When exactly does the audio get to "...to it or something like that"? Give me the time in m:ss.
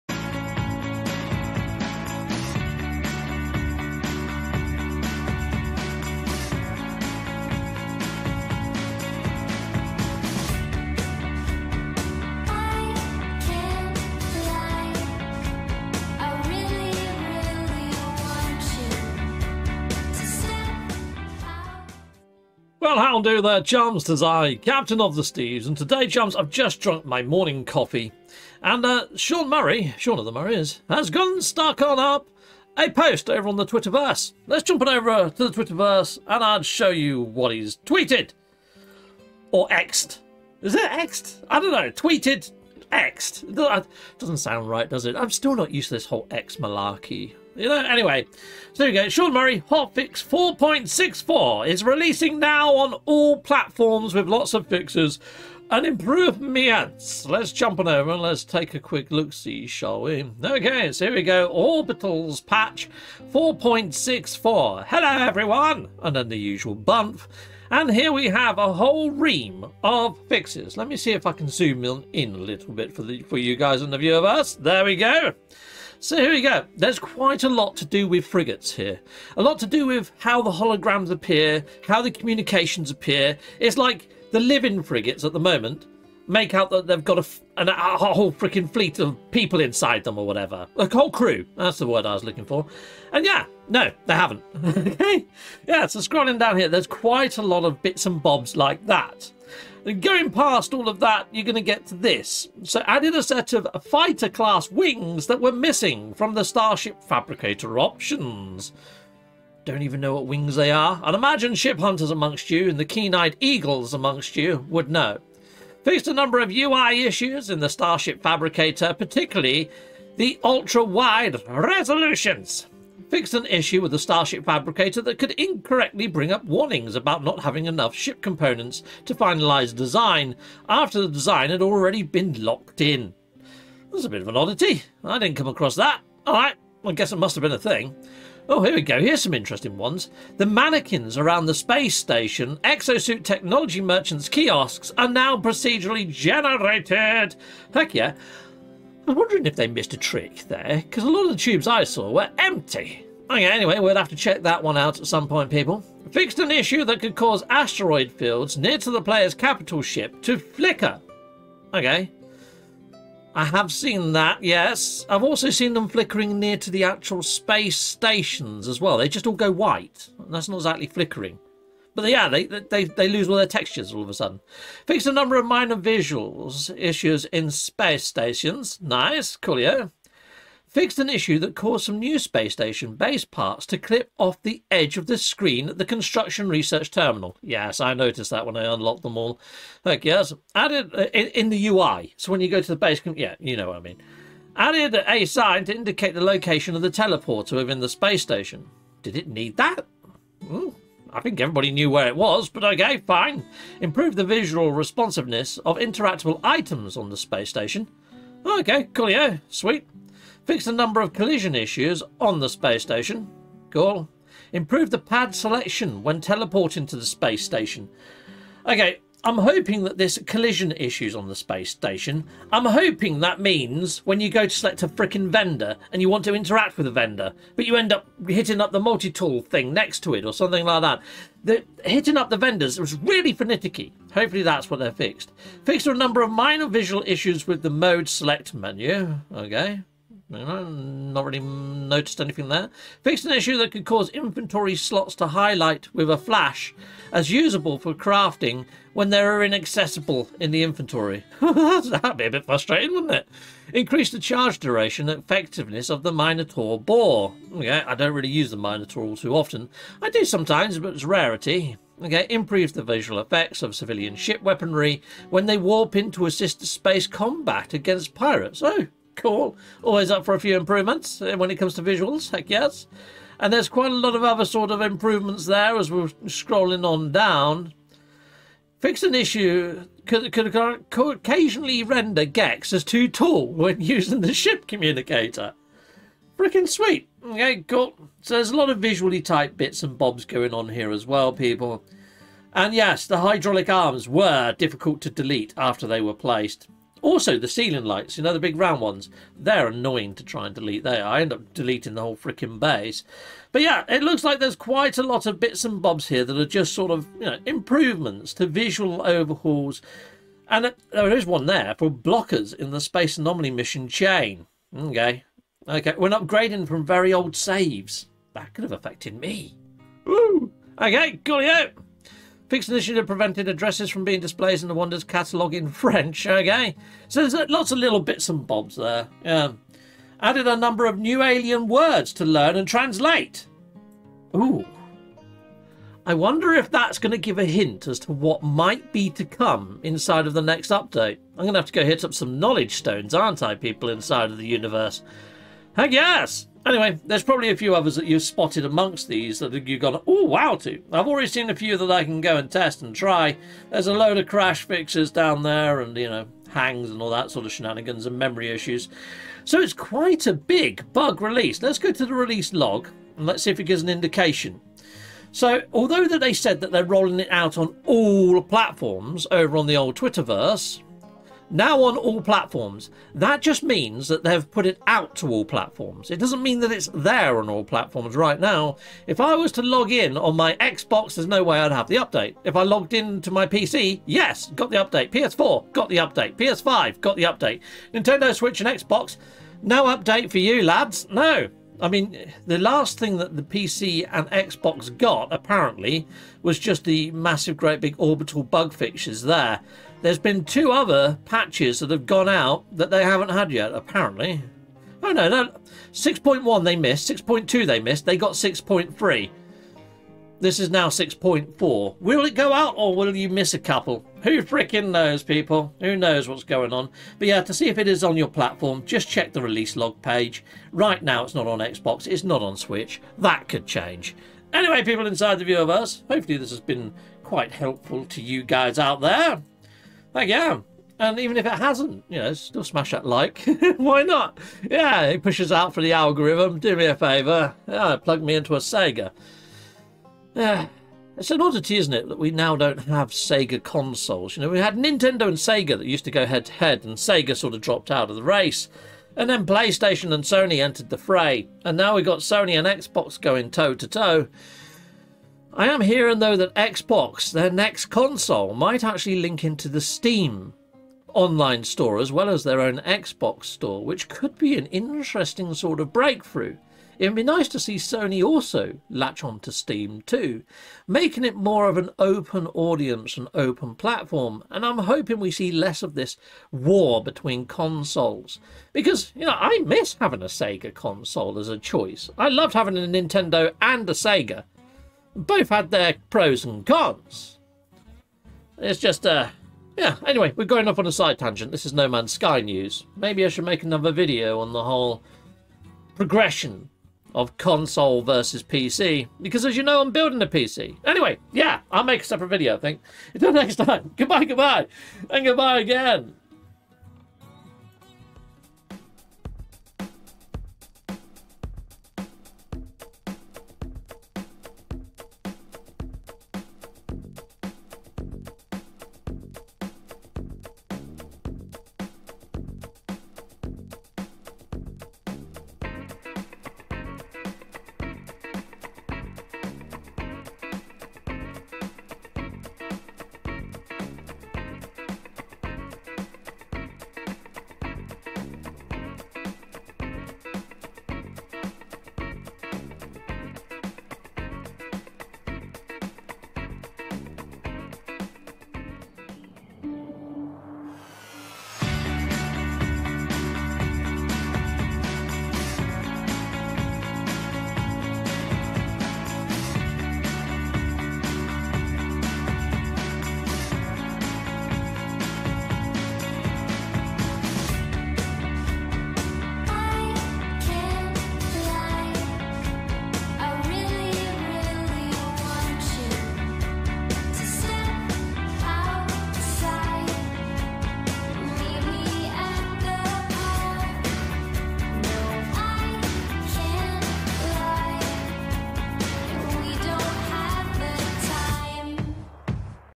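3:50.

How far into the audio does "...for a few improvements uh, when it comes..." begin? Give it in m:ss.
4:30.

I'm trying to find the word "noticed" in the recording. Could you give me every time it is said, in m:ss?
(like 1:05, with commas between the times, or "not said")
3:07, 4:01.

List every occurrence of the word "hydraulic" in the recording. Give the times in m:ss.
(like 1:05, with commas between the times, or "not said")
4:53.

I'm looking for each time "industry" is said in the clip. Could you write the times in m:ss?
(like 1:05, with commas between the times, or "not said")
not said.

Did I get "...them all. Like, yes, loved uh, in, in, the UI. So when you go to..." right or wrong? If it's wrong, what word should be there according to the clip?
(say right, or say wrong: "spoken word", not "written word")
wrong: "added", not "loved".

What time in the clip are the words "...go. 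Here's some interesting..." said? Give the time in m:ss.
2:18.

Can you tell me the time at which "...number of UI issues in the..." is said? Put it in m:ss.
1:56.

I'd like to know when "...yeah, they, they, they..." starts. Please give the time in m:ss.
2:52.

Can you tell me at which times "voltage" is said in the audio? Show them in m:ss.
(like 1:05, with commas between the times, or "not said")
not said.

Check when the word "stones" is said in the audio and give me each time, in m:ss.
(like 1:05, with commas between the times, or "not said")
5:42.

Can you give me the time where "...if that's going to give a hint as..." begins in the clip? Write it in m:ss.
5:36.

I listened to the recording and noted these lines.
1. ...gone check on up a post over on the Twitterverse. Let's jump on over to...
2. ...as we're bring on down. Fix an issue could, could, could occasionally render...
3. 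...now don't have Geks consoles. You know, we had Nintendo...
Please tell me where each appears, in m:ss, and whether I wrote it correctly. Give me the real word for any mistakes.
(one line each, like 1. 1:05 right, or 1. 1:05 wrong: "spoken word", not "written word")
1. 0:31 wrong: "stuck", not "check"
2. 4:35 wrong: "scrolling", not "bring"
3. 7:22 wrong: "Sega", not "Geks".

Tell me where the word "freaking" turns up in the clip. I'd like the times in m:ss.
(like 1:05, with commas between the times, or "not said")
1:28, 4:46, 5:02, 6:54.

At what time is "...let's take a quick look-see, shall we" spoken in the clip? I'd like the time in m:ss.
0:58.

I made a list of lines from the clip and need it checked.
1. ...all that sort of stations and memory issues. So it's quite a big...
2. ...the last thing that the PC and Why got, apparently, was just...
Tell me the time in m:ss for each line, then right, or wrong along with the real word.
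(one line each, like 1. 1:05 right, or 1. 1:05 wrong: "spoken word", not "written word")
1. 5:57 wrong: "shenanigans", not "stations"
2. 6:32 wrong: "Xbox", not "Why".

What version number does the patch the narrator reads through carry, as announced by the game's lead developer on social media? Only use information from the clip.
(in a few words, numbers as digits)
4.64.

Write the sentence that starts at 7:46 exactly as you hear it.
It would be nice to see Sony also latch onto Steam too, making it more of an open audience and open platform.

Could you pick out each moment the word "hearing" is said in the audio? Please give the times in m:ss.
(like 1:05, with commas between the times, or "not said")
7:35.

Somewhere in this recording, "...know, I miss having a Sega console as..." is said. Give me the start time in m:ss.
7:59.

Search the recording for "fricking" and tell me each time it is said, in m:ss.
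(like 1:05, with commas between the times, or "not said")
3:44.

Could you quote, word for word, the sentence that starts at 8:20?
Anyway, yeah, I'll make a separate video, I think.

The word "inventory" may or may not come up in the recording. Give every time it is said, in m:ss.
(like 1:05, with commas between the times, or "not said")
4:04, 4:10.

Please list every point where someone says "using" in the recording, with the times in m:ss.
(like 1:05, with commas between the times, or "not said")
4:43.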